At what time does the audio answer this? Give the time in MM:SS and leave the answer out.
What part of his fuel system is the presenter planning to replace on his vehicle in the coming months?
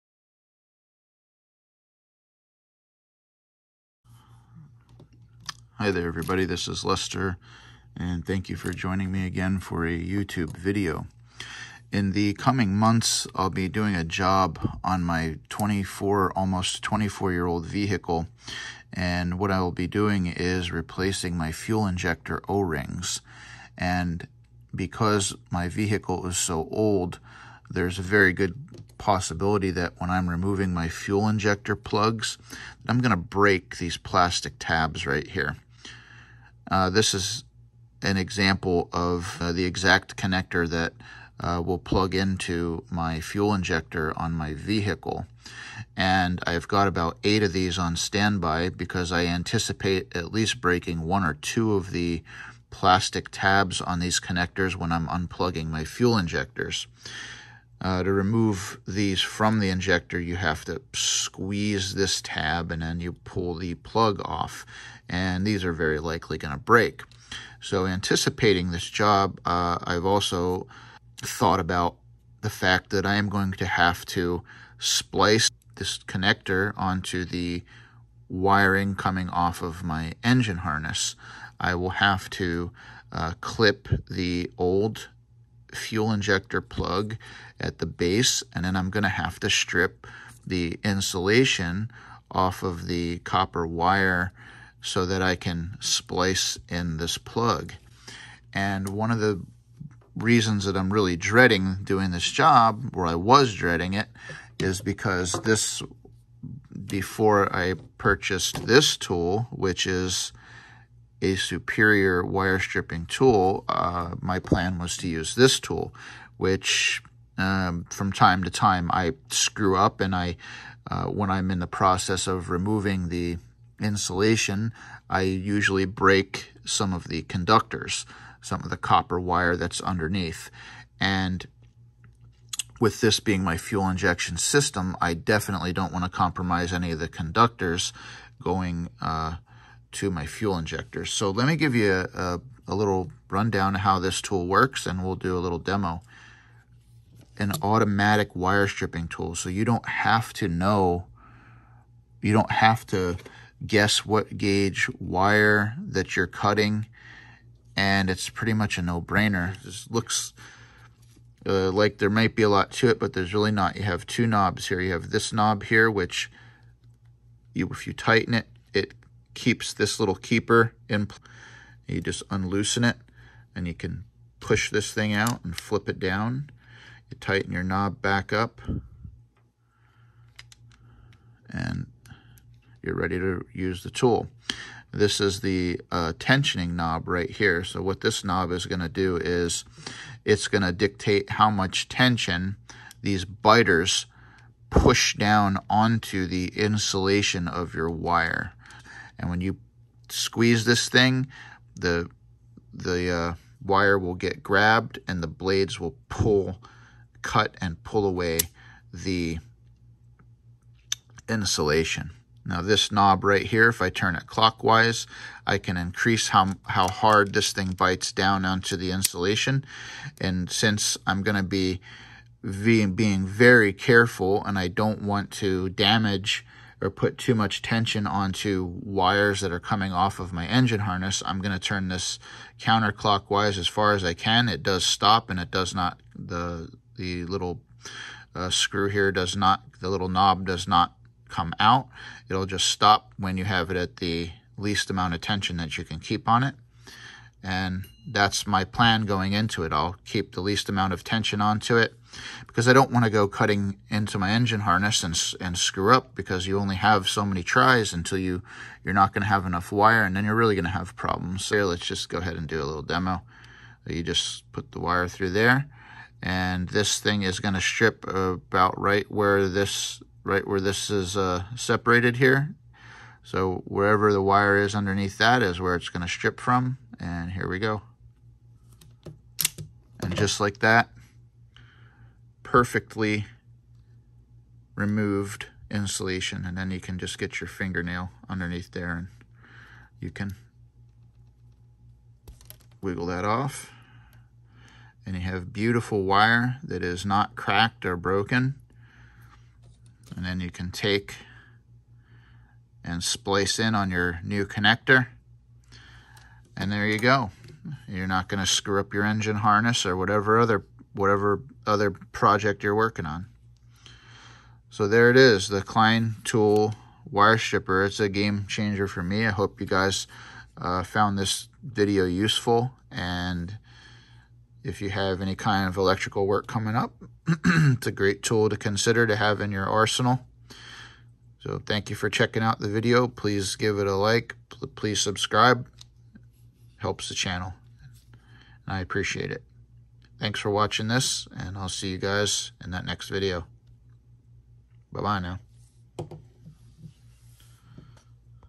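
00:21.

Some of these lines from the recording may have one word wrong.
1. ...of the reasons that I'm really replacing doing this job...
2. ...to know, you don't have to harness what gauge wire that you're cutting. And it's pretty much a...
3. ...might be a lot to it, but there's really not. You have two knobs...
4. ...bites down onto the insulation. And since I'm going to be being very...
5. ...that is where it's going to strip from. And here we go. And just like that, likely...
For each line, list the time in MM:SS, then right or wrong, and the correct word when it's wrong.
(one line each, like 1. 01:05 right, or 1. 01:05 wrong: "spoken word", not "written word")
1. 01:39 wrong: "dreading", not "replacing"
2. 02:30 wrong: "guess", not "harness"
3. 02:42 right
4. 03:37 right
5. 04:35 wrong: "perfectly", not "likely".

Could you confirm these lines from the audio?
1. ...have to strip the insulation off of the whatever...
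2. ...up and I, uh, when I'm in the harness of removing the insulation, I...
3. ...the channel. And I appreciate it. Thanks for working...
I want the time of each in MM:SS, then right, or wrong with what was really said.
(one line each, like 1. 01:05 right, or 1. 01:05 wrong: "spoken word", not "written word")
1. 01:29 wrong: "copper", not "whatever"
2. 01:59 wrong: "process", not "harness"
3. 05:37 wrong: "watching", not "working".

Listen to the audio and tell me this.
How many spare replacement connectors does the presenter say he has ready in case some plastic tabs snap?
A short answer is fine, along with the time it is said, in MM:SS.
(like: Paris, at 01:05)
8, at 00:47.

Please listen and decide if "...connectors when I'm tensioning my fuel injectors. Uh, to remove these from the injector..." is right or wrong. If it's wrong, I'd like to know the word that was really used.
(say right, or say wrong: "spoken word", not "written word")
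wrong: "unplugging", not "tensioning".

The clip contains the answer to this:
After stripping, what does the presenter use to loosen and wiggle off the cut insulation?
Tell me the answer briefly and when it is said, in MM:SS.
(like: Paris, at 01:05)
fingernail, at 04:47.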